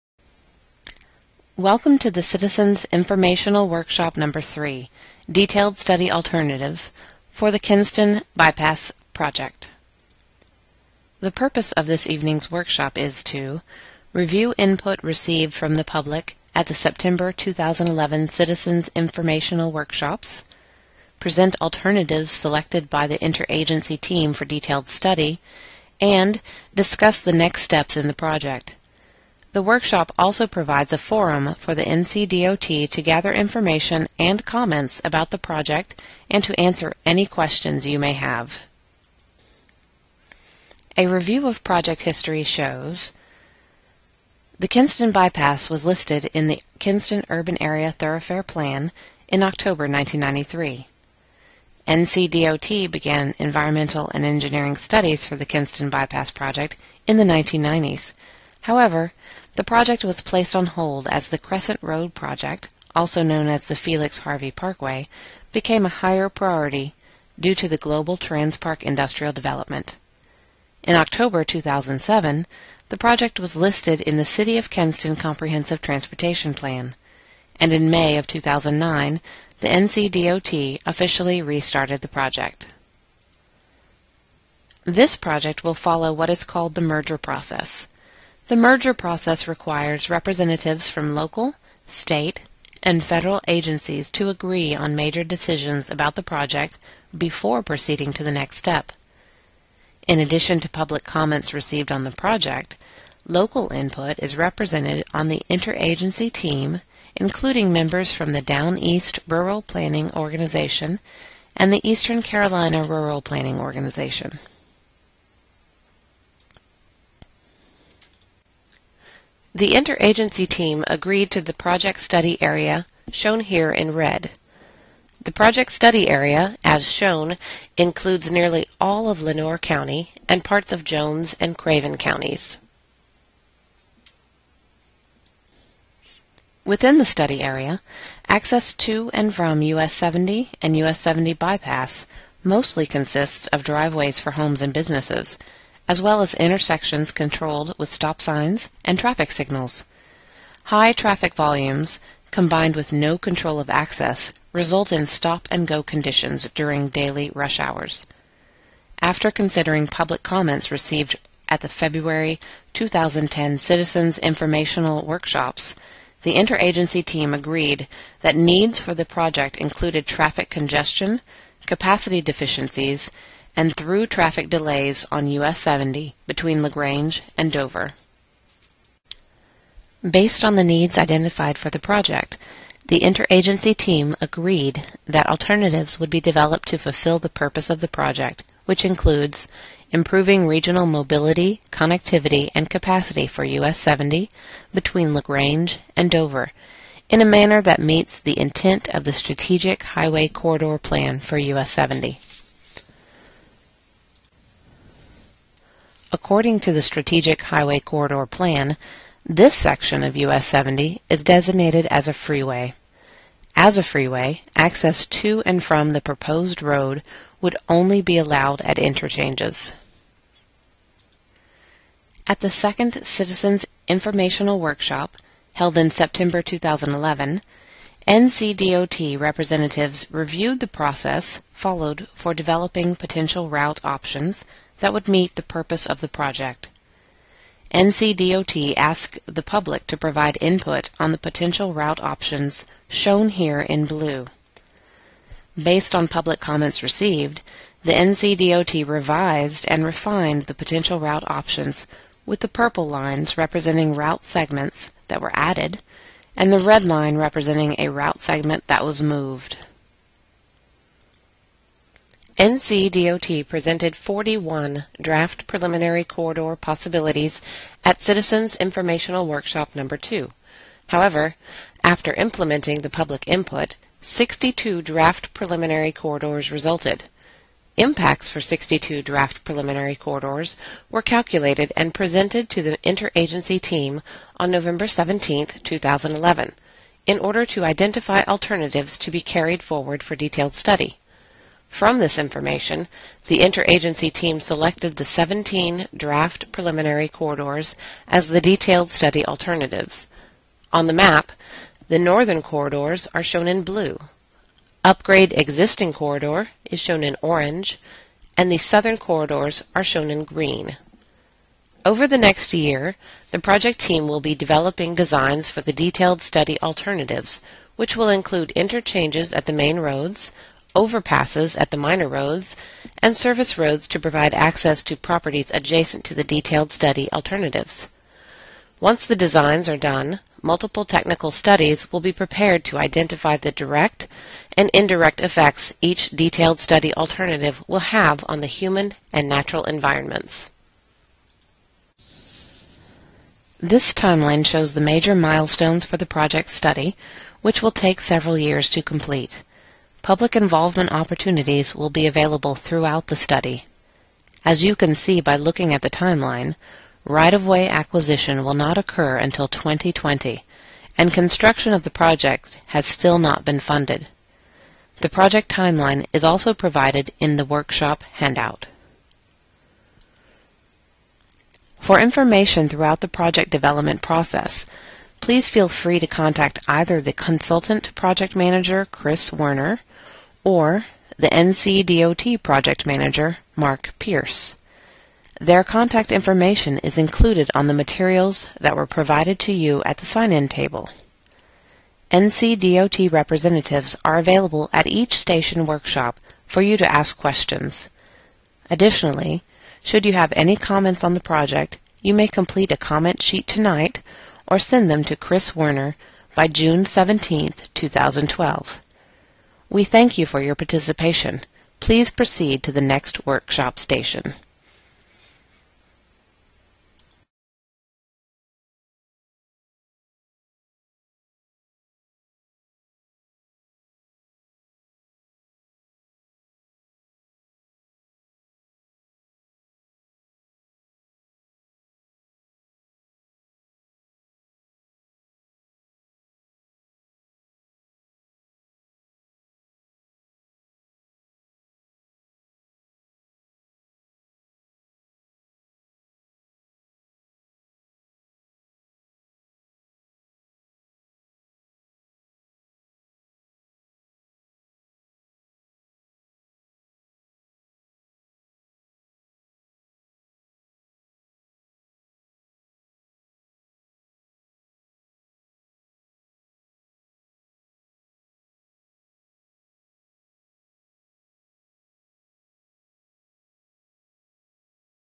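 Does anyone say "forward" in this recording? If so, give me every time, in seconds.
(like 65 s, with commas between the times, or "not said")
289 s.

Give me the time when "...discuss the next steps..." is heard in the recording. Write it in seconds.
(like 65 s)
26 s.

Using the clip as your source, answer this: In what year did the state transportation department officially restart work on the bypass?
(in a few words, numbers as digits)
2009.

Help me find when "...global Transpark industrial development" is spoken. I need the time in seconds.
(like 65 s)
67 s.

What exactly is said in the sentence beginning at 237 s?
NCDOT asked the public to provide input on the potential route options shown here in blue.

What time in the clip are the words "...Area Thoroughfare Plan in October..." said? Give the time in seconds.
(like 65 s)
47 s.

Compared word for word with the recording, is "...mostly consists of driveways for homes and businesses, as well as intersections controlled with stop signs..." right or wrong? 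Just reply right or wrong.
right.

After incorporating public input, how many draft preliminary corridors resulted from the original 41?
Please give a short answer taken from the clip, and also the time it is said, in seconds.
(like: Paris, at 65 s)
62, at 274 s.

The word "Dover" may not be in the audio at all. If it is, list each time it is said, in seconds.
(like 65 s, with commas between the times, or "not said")
177 s, 196 s.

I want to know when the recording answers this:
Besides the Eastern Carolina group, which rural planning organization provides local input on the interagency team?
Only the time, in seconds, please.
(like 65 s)
108 s.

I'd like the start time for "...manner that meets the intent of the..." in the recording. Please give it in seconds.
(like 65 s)
197 s.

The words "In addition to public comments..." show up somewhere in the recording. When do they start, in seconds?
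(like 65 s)
100 s.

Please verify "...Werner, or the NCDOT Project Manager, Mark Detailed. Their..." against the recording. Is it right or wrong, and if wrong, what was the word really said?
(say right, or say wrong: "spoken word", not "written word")
wrong: "Pierce", not "Detailed".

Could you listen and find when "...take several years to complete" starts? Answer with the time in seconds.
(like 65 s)
347 s.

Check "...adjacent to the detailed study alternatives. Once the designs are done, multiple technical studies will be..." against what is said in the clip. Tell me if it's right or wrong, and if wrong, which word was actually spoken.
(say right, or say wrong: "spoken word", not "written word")
right.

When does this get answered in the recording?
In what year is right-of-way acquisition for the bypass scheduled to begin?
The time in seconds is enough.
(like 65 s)
359 s.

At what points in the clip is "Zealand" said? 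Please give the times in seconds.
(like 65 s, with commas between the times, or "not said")
not said.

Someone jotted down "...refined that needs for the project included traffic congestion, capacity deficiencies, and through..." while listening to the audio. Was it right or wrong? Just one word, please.
wrong.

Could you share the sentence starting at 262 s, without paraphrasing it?
NCDOT presented 41 draft preliminary corridor possibilities at Citizens Informational Workshop Number 2.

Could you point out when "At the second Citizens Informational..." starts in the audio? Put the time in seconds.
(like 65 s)
222 s.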